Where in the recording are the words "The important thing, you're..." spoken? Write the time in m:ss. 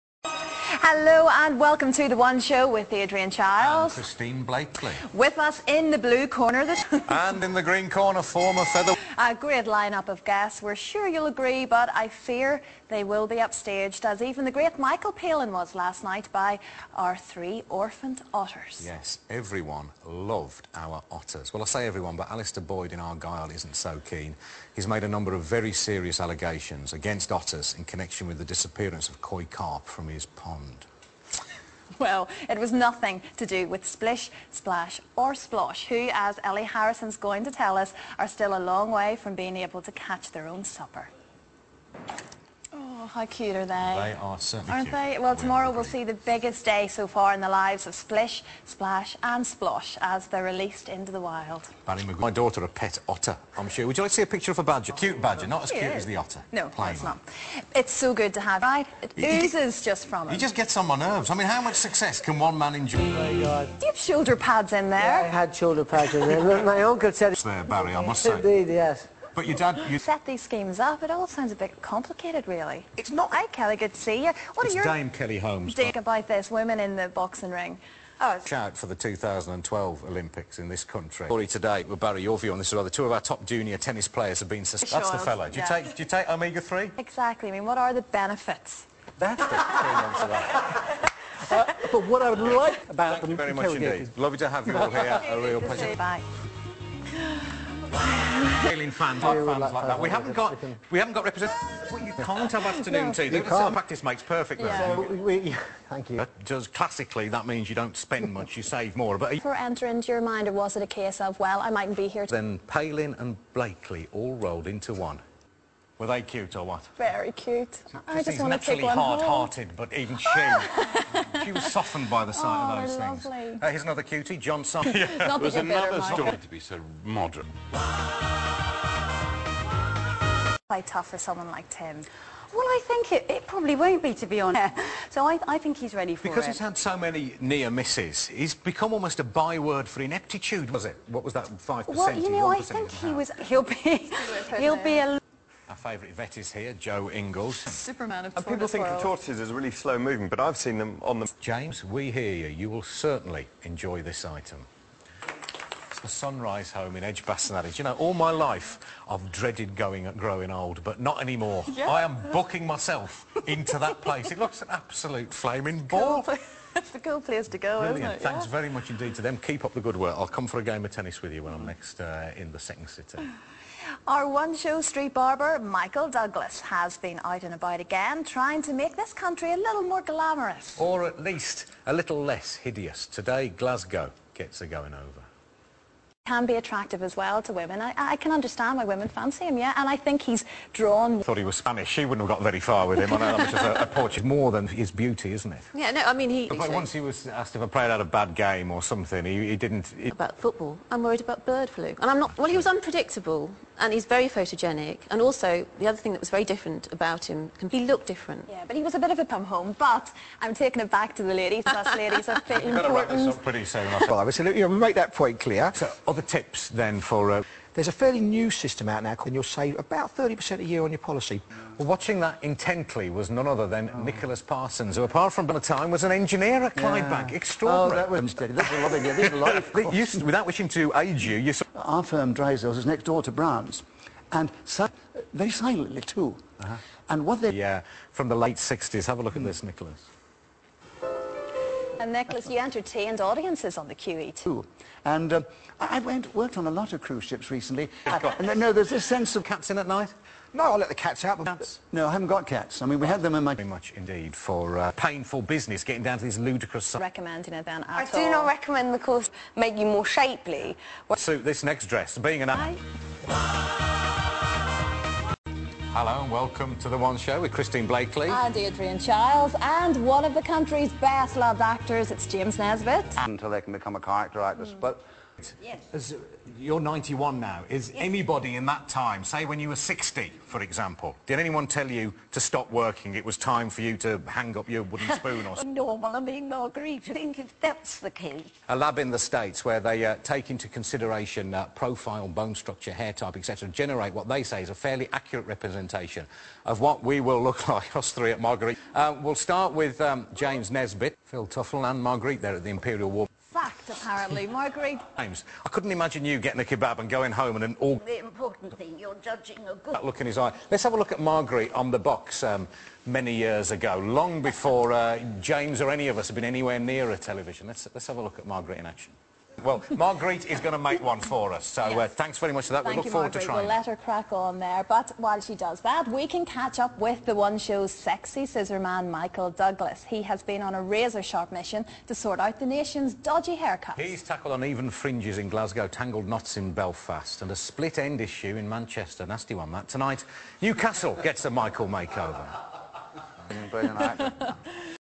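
5:08.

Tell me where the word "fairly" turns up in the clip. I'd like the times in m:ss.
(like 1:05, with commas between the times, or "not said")
3:37, 4:54.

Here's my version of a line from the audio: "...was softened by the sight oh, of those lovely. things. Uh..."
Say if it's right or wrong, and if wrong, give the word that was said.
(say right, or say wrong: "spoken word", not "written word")
right.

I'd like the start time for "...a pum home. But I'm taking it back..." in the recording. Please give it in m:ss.
3:29.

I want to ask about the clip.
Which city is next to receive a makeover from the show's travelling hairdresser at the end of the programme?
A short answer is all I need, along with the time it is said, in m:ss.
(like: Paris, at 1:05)
Newcastle, at 5:40.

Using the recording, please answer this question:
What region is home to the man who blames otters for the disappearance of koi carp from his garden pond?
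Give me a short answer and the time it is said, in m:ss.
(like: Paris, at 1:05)
Argyll, at 0:22.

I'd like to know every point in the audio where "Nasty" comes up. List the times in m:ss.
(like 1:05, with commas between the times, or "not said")
5:39.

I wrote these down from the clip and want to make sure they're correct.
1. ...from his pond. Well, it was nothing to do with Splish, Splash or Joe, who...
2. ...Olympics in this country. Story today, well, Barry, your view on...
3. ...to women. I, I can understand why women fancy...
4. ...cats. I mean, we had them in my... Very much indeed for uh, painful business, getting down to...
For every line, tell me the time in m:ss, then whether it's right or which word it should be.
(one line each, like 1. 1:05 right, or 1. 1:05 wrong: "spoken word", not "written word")
1. 0:29 wrong: "Splosh", not "Joe"
2. 1:20 right
3. 3:07 right
4. 4:12 right.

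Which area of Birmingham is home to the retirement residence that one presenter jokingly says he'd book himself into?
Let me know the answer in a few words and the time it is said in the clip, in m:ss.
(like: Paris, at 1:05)
Edgbaston, at 2:37.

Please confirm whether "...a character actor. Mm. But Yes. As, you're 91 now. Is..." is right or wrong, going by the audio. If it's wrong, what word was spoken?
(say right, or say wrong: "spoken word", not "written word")
right.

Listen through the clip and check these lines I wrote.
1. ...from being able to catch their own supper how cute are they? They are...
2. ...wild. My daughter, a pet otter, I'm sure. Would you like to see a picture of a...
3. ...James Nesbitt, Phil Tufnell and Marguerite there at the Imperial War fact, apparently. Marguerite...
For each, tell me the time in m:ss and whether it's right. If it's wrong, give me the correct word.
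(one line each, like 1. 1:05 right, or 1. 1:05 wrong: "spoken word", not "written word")
1. 0:39 right
2. 0:51 right
3. 5:00 right.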